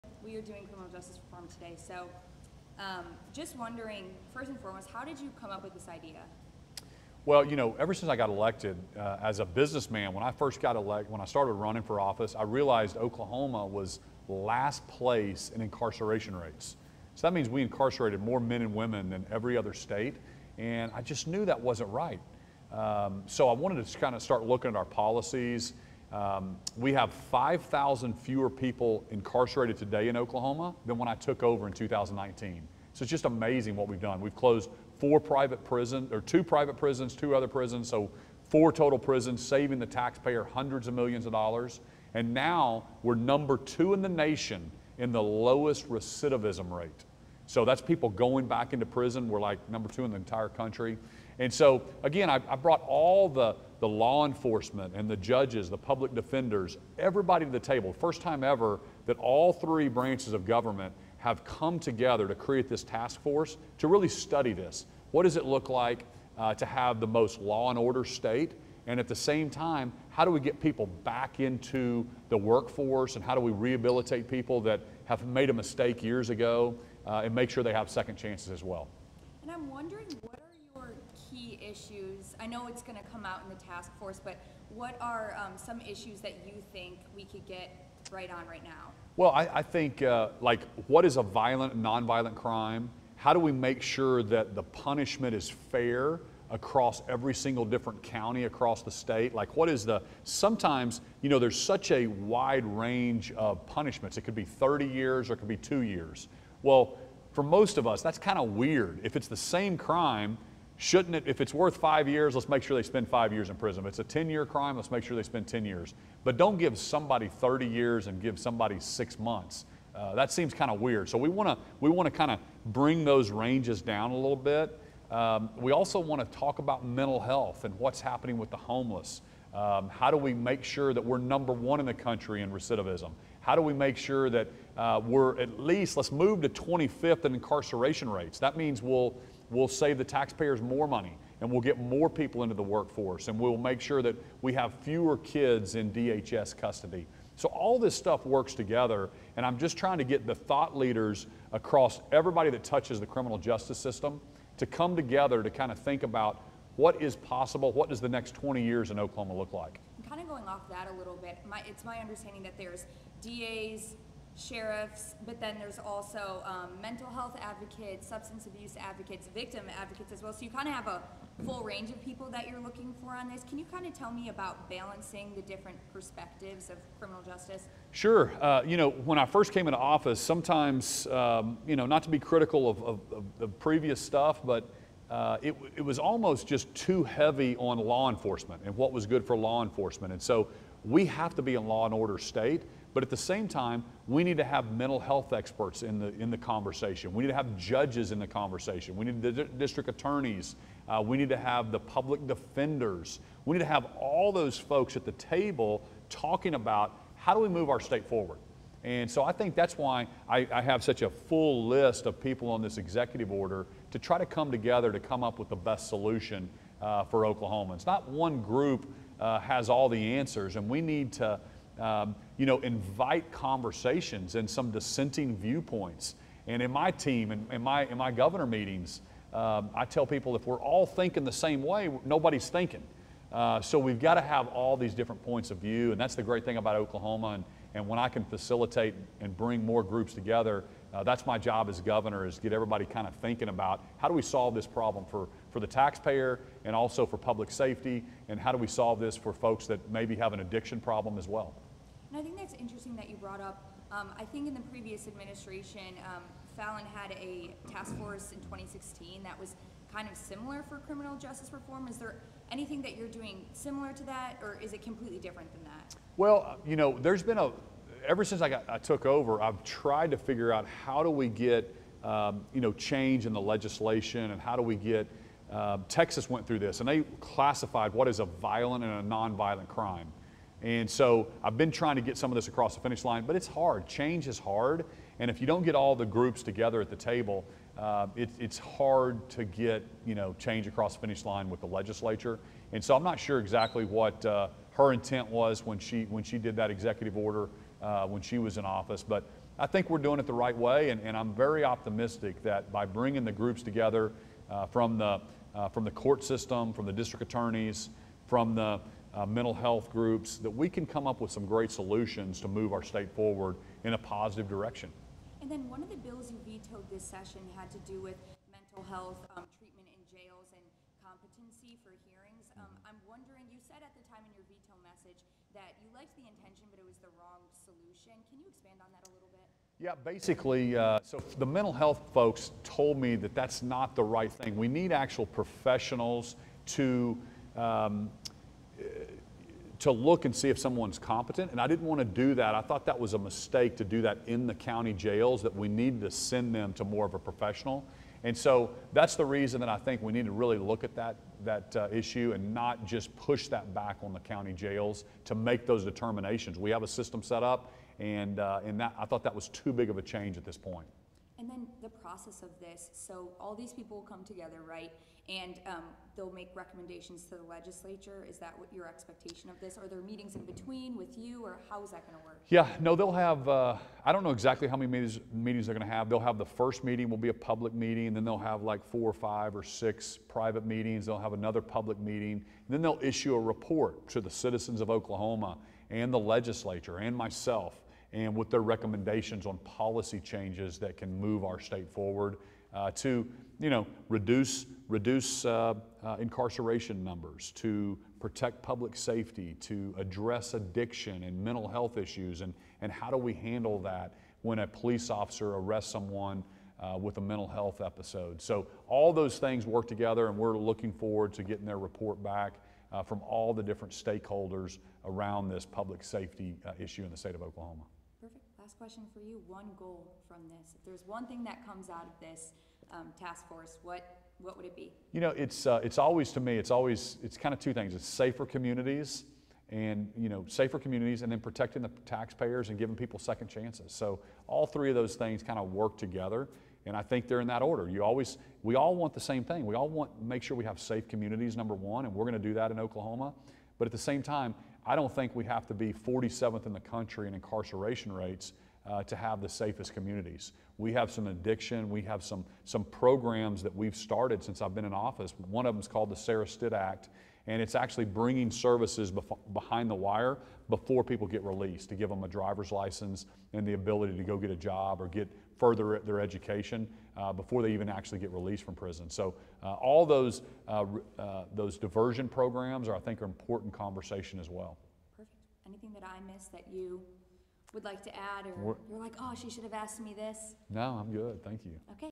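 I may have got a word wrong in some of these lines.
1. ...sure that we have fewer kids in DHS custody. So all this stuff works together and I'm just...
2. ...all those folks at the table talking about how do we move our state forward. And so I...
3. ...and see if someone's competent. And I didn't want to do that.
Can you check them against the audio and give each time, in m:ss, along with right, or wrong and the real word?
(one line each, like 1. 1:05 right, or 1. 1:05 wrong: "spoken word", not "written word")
1. 2:23 right
2. 3:23 right
3. 5:40 right.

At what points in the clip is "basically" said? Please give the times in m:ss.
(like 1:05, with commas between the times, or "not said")
5:30.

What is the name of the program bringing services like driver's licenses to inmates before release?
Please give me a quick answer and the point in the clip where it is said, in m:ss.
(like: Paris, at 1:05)
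Sarah Stitt Act, at 7:36.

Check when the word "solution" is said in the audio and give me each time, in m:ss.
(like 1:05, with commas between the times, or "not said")
3:35, 5:11, 5:27.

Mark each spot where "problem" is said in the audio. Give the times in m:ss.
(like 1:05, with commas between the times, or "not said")
4:04, 4:10.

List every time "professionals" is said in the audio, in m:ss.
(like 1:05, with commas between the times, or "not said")
5:35, 5:47.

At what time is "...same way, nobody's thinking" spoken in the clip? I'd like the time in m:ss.
3:51.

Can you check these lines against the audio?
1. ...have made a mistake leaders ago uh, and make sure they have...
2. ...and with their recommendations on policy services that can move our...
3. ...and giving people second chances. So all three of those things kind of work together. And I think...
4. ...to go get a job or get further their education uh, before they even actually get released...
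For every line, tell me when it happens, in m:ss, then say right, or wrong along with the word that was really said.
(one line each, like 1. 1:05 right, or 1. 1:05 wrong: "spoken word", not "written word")
1. 1:15 wrong: "years", not "leaders"
2. 6:28 wrong: "changes", not "services"
3. 7:12 right
4. 7:44 right.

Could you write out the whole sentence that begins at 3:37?
Not one group uh, has all the answers, and we need to.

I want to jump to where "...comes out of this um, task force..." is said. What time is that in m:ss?
7:01.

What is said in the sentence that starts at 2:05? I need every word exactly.
Um, we also want to talk about mental health and what's happening with the homeless.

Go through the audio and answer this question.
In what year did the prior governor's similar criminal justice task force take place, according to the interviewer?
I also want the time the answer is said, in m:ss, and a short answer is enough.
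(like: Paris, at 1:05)
2016, at 4:18.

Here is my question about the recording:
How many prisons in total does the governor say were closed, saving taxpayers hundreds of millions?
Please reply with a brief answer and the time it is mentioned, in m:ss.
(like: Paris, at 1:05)
4, at 0:38.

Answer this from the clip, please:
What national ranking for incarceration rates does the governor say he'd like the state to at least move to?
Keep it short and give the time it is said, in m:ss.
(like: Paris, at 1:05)
25th, at 2:16.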